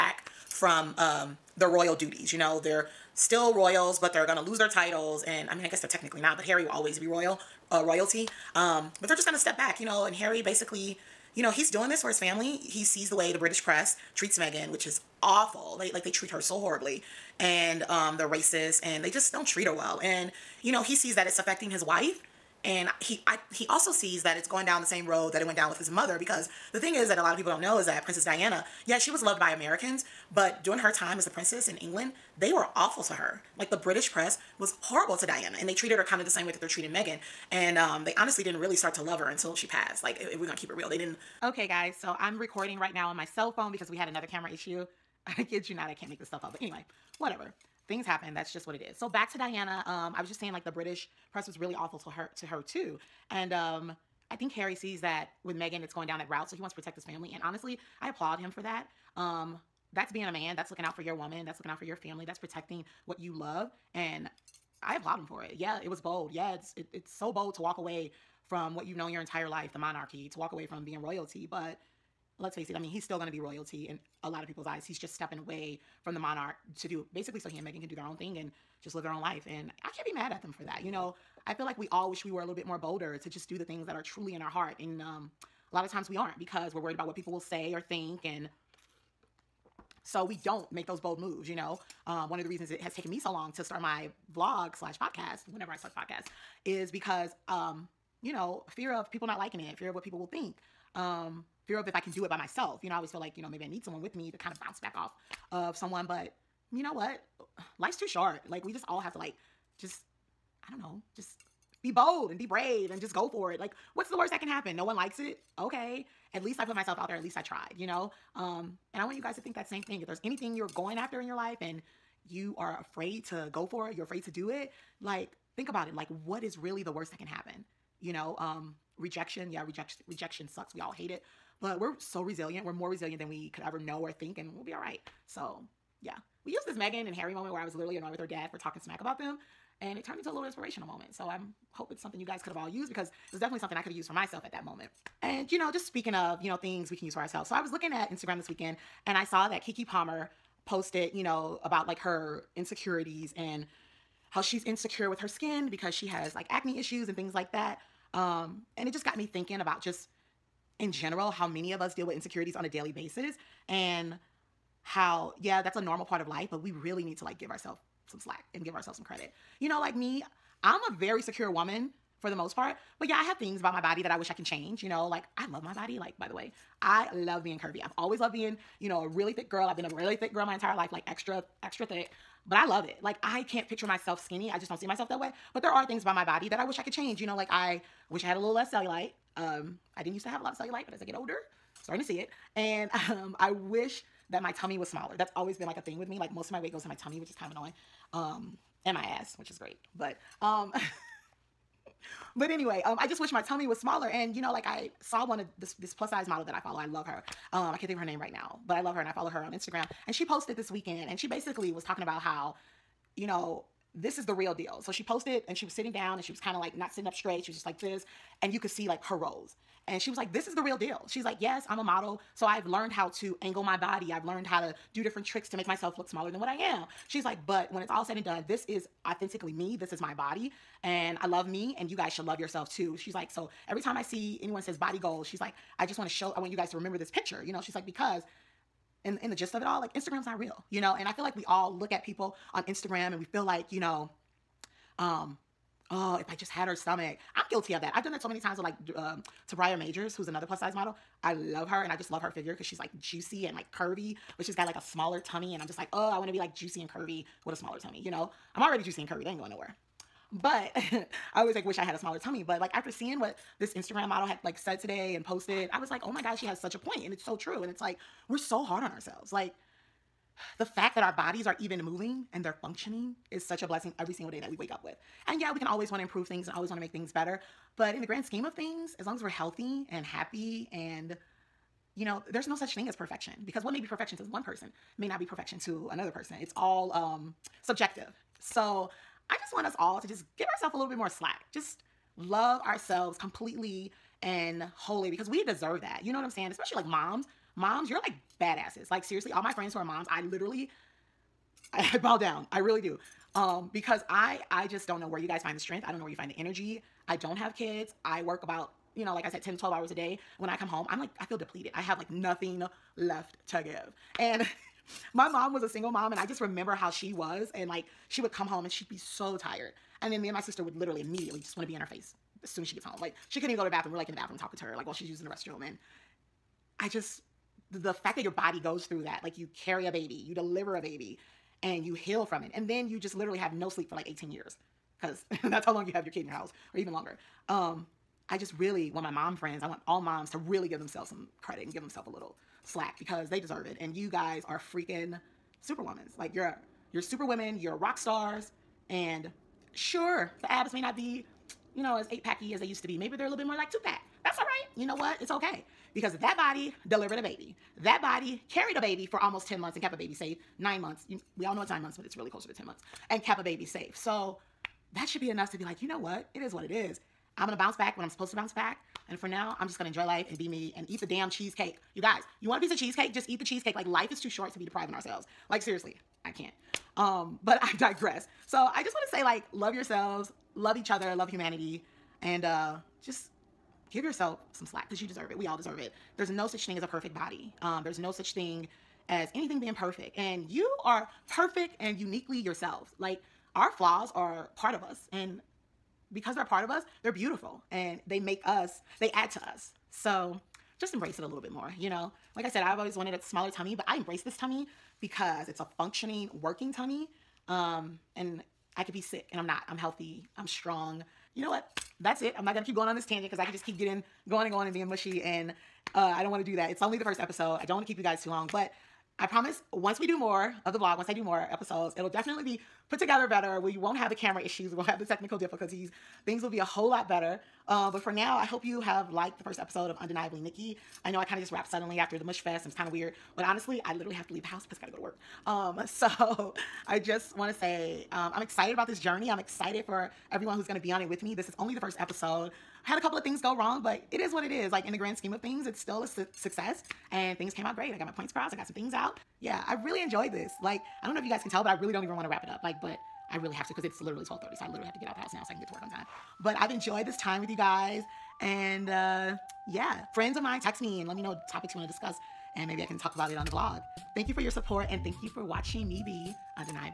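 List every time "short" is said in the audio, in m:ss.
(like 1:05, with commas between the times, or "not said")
1:48, 6:14.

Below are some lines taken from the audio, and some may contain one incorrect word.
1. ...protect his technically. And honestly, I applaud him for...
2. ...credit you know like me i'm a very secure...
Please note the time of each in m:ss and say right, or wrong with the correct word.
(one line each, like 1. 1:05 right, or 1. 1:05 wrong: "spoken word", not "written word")
1. 0:56 wrong: "family", not "technically"
2. 2:49 right.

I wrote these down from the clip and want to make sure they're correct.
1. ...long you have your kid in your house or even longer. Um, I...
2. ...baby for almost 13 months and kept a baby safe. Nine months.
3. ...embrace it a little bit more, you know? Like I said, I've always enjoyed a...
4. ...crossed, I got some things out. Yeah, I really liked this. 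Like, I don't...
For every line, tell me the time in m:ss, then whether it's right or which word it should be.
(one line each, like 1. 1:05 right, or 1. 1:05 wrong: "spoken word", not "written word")
1. 5:35 right
2. 5:58 wrong: "10", not "13"
3. 6:40 wrong: "wanted", not "enjoyed"
4. 7:28 wrong: "enjoyed", not "liked".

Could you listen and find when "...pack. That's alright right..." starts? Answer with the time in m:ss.
5:53.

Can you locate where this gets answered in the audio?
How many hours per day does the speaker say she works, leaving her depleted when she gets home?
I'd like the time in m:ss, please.
5:09.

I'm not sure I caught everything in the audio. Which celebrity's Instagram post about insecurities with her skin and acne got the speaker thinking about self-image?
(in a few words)
Keke Palmer.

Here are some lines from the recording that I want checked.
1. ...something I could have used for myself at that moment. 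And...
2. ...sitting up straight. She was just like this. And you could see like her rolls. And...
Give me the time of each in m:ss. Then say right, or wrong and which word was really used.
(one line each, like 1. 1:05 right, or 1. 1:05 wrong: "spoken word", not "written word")
1. 2:23 right
2. 3:36 right.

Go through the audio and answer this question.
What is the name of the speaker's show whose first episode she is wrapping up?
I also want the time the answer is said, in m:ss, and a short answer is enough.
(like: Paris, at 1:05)
Undeniably Nikki, at 7:09.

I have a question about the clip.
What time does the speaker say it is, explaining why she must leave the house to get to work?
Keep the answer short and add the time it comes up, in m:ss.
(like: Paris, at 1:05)
12:30, at 7:34.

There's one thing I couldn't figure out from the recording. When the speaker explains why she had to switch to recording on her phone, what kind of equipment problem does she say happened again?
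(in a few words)
camera issue.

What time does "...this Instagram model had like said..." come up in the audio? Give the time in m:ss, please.
4:23.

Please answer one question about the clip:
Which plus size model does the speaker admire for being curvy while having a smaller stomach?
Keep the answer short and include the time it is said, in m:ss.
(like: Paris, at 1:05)
Tabria Majors, at 4:09.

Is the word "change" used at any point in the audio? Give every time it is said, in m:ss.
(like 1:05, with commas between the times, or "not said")
2:54, 3:06.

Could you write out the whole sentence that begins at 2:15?
So, yeah we used this Meghan and Harry moment where I was literally annoyed with her dad for talking smack about them.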